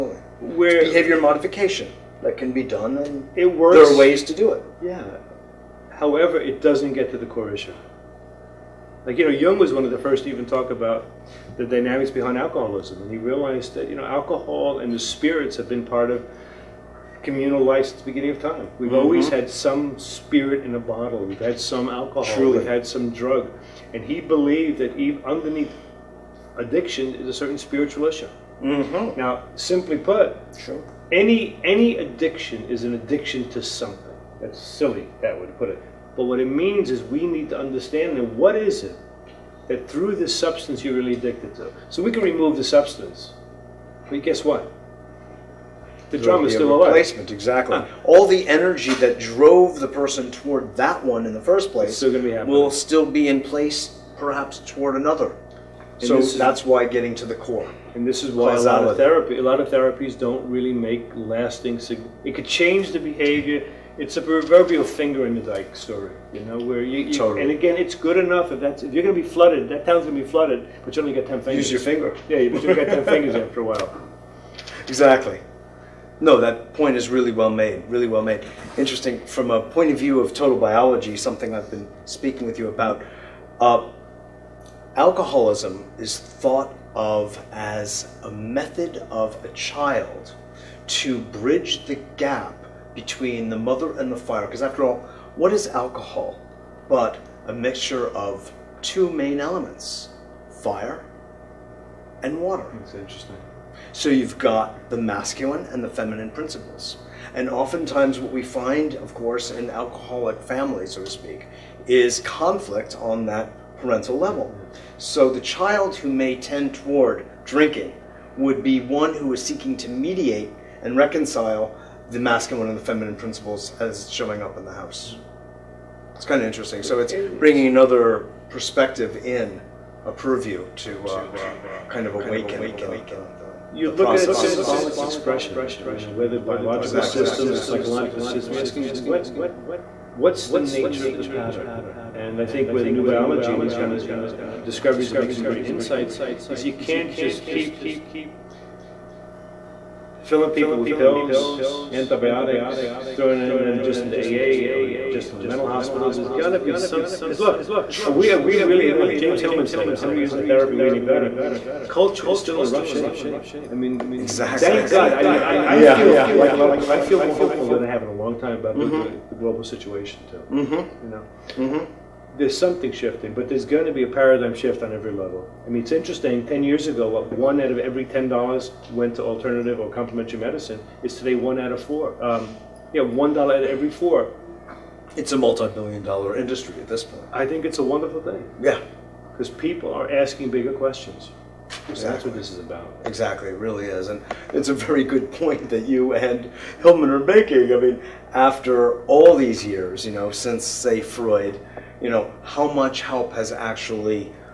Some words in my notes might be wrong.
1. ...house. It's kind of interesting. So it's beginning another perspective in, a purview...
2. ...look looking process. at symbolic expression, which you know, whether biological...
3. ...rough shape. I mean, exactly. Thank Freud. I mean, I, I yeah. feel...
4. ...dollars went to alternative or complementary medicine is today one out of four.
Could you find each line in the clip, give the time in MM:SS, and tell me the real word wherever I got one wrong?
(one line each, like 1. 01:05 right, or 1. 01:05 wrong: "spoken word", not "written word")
1. 02:04 wrong: "bringing", not "beginning"
2. 02:13 right
3. 02:42 wrong: "God", not "Freud"
4. 02:58 right.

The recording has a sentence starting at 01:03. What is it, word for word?
It's a proverbial finger in the dike story, you know, where you, you totally.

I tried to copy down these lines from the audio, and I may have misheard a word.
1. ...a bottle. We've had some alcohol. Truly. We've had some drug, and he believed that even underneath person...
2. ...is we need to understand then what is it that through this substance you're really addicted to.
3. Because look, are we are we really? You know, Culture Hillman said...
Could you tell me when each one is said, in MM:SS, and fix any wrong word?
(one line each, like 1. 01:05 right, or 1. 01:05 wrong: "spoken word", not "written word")
1. 00:20 wrong: "addiction", not "person"
2. 00:36 right
3. 02:37 wrong: "James", not "Culture".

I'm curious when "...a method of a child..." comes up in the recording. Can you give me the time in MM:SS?
01:28.